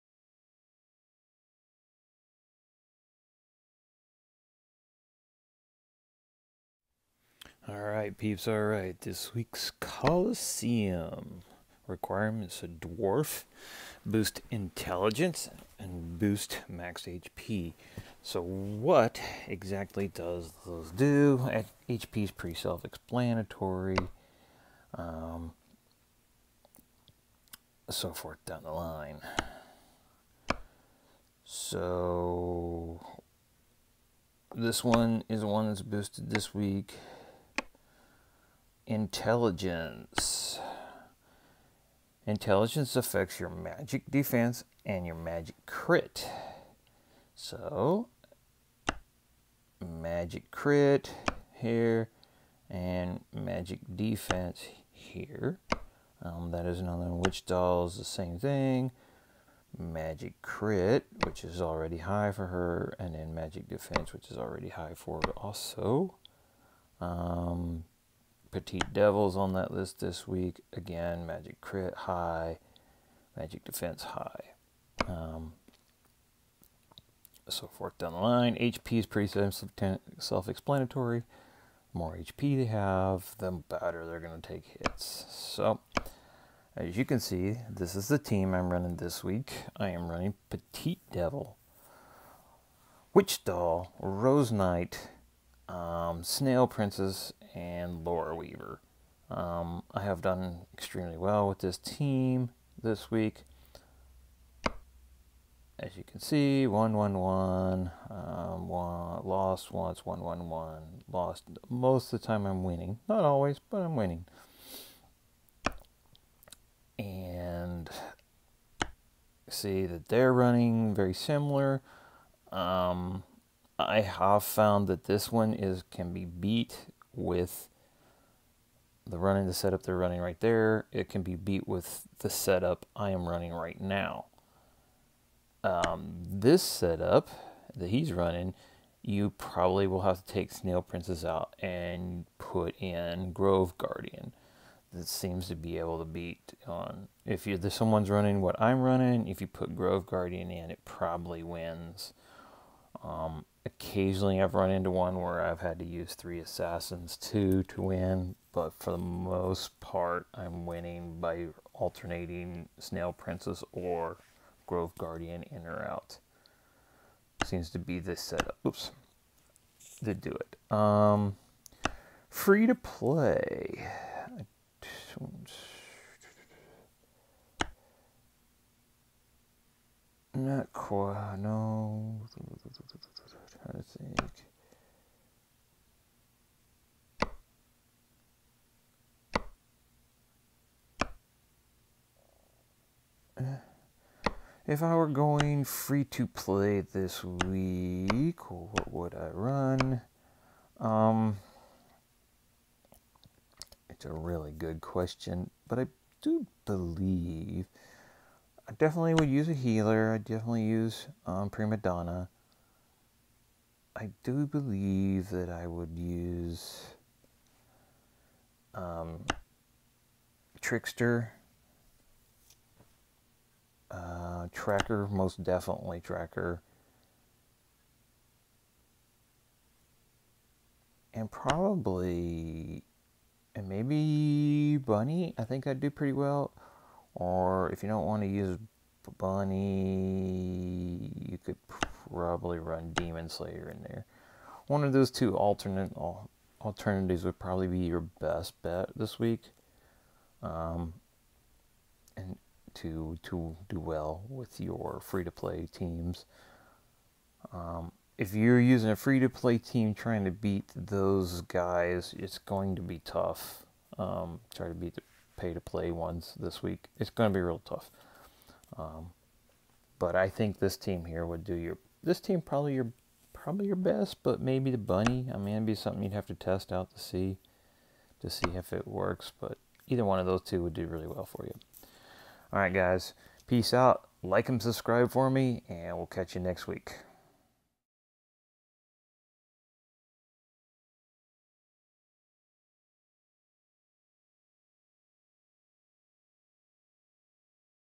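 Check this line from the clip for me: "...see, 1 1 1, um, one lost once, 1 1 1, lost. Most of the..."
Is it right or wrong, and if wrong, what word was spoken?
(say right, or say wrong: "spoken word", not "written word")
right.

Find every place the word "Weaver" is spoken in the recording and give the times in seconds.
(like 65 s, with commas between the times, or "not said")
98 s.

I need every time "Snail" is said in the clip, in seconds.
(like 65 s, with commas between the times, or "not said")
96 s, 140 s, 162 s.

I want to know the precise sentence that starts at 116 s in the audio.
And see that they're running very similar.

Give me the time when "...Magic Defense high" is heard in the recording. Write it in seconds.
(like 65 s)
73 s.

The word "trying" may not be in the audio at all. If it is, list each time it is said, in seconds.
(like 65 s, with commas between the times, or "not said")
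183 s, 259 s.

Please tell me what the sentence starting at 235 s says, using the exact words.
I think I'd do pretty well.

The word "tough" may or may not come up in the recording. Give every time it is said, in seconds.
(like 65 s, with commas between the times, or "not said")
262 s, 267 s.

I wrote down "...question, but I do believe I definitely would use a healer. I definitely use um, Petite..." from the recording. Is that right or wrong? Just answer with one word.
wrong.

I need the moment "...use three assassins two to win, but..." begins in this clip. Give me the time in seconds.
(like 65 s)
155 s.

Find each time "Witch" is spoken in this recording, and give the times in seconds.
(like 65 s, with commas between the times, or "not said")
57 s, 93 s.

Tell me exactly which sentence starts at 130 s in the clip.
It can be beat with the setup I am running right now.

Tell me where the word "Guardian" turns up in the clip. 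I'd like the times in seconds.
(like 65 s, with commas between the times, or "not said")
143 s, 150 s, 164 s.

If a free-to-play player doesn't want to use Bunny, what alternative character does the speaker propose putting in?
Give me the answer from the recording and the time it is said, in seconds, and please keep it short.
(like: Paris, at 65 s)
Demon Slayer, at 242 s.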